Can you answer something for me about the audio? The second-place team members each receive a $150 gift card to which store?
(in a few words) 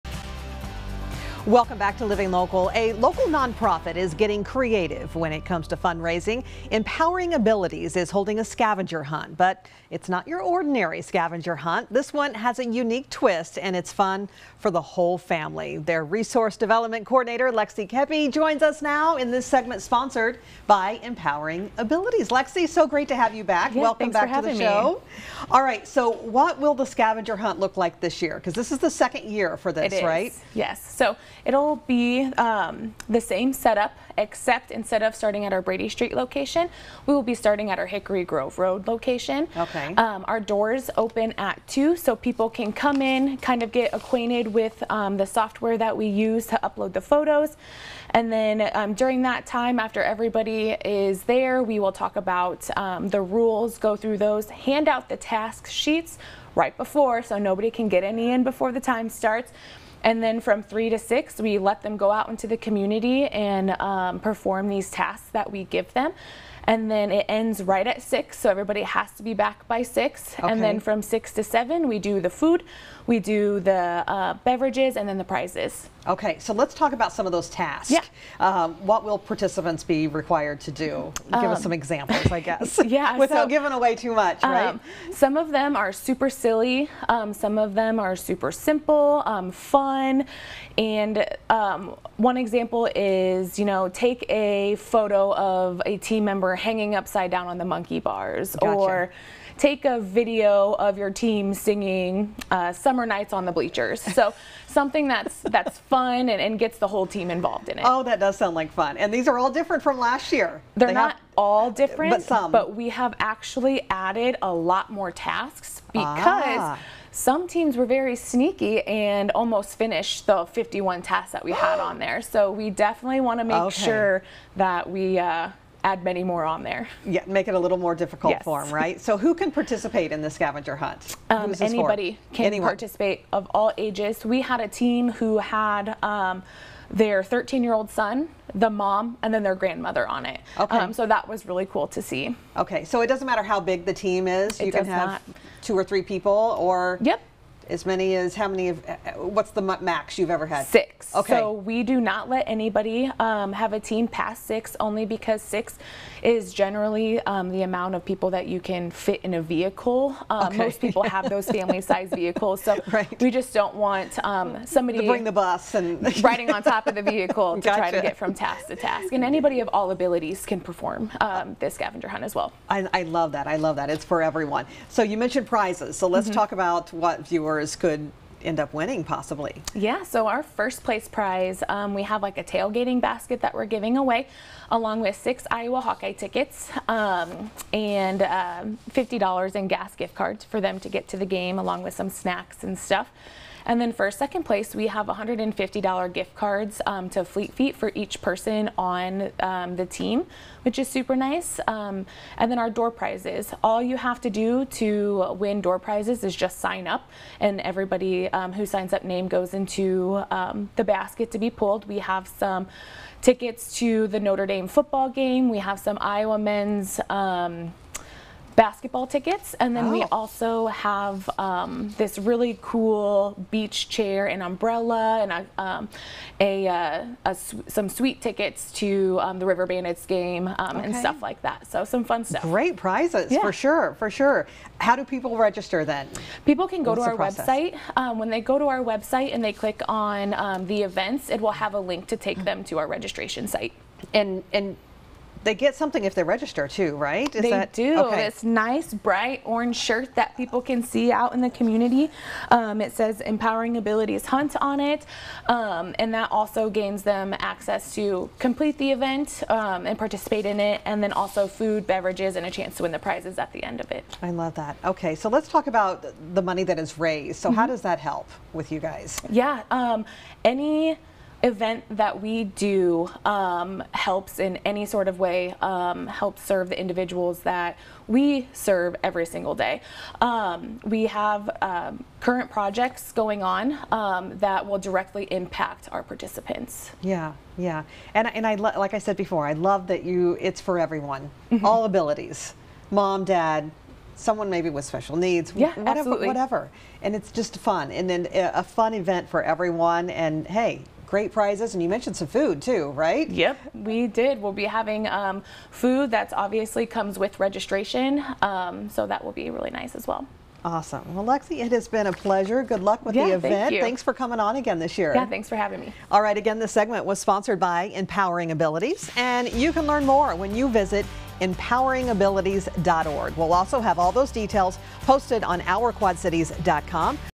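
Fleet Feet.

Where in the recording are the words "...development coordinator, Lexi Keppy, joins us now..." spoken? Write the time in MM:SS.
00:16.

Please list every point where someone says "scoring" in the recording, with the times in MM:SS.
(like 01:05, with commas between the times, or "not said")
not said.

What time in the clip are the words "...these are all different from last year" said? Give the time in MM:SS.
01:49.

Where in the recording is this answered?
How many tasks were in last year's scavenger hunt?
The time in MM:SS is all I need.
02:00.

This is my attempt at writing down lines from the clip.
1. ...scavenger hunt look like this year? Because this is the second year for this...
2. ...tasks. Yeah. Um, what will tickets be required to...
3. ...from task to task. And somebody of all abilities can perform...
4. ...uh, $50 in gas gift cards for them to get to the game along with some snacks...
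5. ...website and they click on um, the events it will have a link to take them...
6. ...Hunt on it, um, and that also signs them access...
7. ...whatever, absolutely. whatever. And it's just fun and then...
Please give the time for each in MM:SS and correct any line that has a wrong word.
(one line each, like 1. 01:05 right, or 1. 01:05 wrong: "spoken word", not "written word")
1. 00:26 right
2. 01:17 wrong: "participants", not "tickets"
3. 02:48 wrong: "anybody", not "somebody"
4. 03:08 right
5. 03:58 right
6. 04:14 wrong: "gains", not "signs"
7. 04:55 right.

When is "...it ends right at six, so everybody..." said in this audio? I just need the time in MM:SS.
01:07.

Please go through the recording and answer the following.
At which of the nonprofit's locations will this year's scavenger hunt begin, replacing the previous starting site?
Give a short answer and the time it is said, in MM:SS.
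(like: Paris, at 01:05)
Hickory Grove Road, at 00:37.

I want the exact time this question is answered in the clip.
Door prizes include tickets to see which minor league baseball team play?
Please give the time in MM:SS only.
03:49.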